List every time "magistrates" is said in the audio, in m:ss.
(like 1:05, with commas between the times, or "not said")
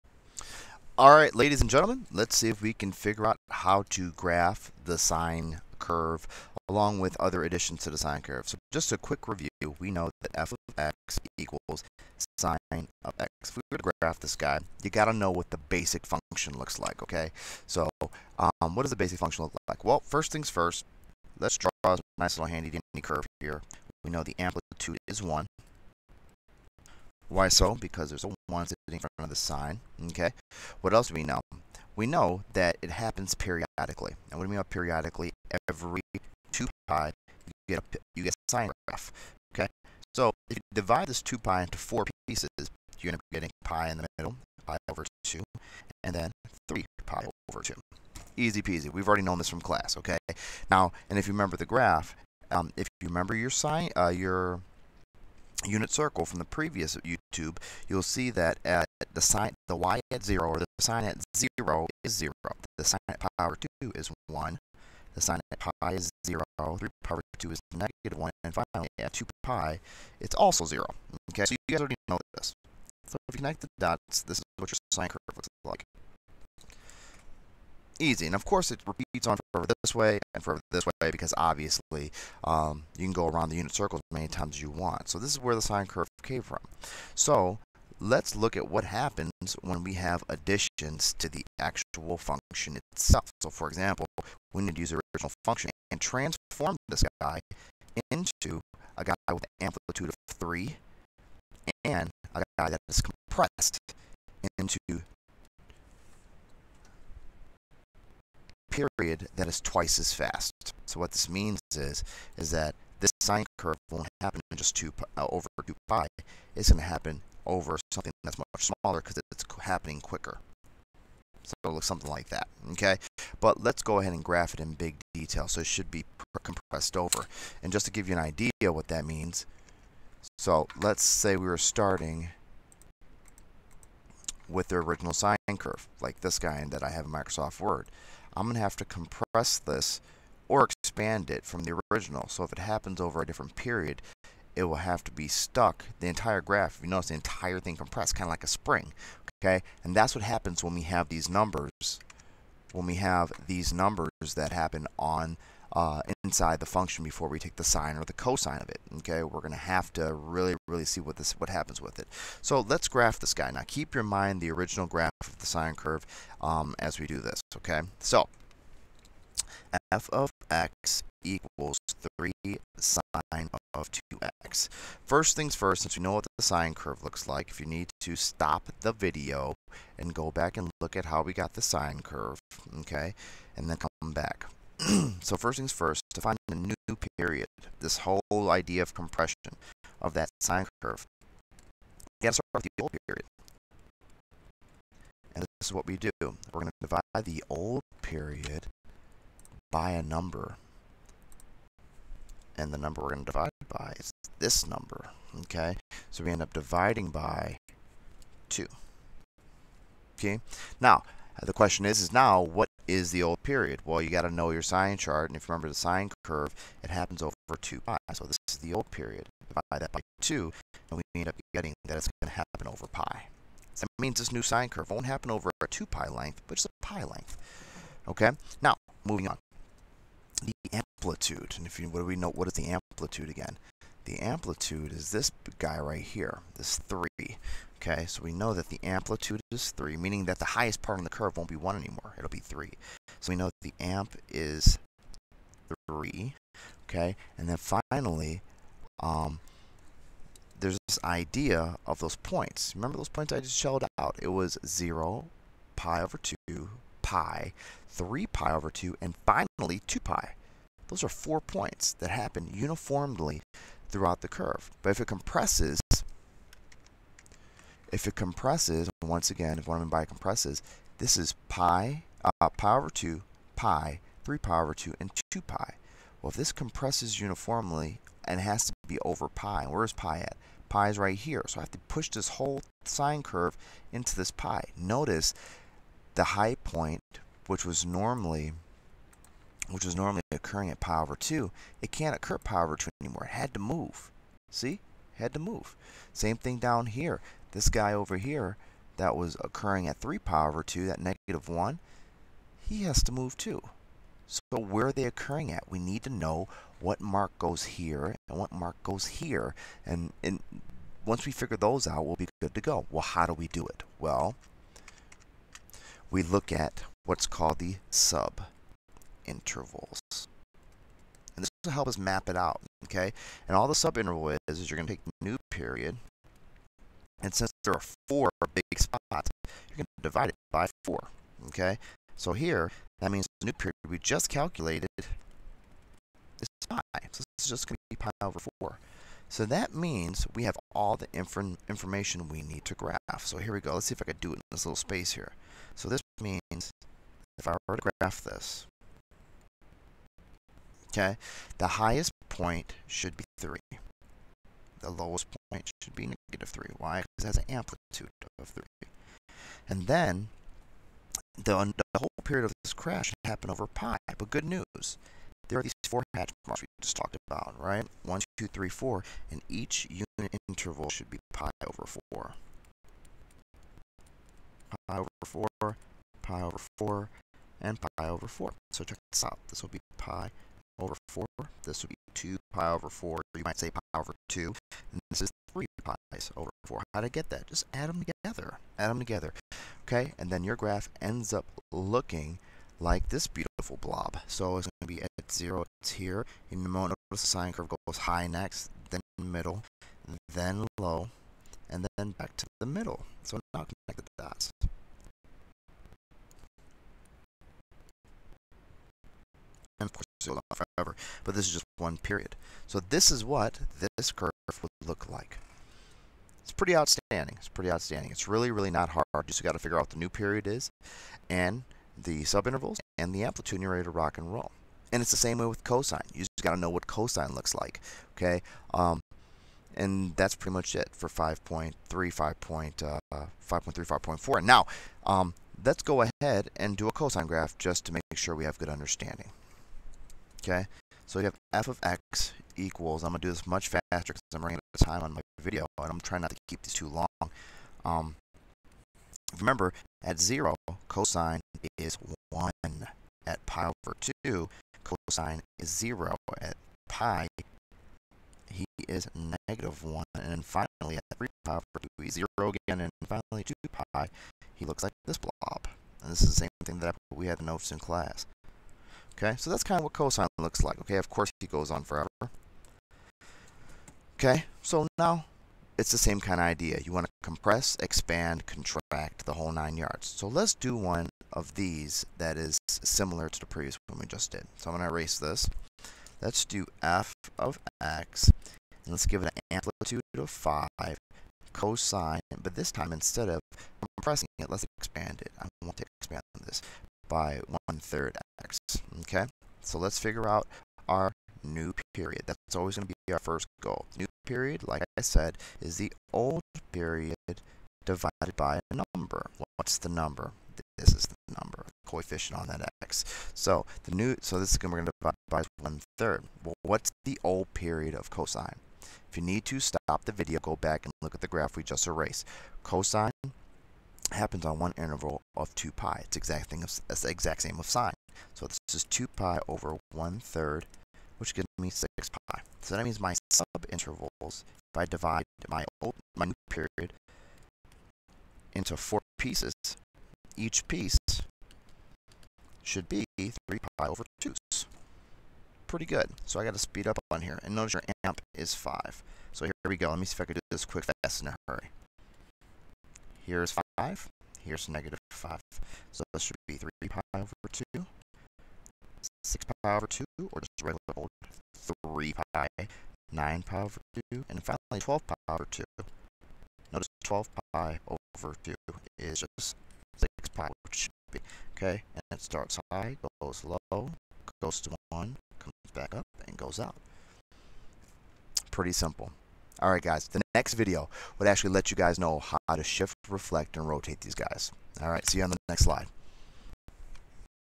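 not said.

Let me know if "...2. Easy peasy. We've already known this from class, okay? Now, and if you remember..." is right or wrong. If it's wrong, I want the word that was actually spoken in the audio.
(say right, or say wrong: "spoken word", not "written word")
right.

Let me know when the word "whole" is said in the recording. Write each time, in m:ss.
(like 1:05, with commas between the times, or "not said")
3:07, 4:42, 6:01, 7:59.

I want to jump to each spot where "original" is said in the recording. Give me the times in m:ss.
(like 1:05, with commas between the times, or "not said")
1:35, 2:14, 2:21, 2:44.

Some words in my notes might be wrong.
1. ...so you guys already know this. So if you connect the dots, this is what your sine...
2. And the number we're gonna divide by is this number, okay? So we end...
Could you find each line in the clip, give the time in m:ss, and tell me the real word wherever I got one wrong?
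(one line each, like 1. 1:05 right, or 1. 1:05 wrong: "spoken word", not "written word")
1. 1:11 right
2. 3:22 right.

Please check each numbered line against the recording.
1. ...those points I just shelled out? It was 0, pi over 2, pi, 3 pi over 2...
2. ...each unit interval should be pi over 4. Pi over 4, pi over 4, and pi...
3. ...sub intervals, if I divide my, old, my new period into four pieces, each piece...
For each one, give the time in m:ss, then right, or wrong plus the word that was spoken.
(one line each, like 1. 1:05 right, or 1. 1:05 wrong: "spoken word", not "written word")
1. 4:12 right
2. 6:09 right
3. 8:53 right.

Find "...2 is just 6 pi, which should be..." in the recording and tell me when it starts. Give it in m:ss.
9:28.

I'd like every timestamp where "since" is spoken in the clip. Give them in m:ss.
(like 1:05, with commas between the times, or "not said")
2:55, 5:27.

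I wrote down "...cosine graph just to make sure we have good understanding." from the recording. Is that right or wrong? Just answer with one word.
right.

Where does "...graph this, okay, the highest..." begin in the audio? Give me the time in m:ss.
5:48.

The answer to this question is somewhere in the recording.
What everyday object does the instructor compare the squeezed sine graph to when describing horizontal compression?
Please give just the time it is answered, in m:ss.
2:28.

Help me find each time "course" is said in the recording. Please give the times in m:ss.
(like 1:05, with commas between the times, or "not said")
1:18, 7:51.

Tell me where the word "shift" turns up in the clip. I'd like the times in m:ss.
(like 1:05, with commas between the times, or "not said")
9:42.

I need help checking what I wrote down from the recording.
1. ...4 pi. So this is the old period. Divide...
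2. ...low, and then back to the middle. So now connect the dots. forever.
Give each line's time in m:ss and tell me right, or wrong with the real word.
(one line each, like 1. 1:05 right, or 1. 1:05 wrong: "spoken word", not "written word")
1. 3:37 wrong: "2", not "4"
2. 6:40 right.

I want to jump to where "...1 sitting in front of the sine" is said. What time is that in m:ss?
0:28.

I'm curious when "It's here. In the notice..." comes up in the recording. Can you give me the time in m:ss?
6:35.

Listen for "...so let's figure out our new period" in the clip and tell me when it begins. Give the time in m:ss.
8:19.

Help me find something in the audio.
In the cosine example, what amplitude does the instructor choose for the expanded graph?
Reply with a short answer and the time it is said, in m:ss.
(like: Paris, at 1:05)
5, at 8:09.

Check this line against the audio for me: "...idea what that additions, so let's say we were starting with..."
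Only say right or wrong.
wrong.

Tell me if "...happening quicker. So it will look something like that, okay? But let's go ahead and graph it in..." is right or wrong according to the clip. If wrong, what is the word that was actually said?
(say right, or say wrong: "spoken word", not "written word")
right.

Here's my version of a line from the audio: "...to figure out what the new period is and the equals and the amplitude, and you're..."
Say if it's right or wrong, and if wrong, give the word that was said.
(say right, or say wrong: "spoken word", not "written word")
wrong: "subintervals", not "equals".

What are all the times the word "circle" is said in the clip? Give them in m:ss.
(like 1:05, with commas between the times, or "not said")
0:55, 1:23.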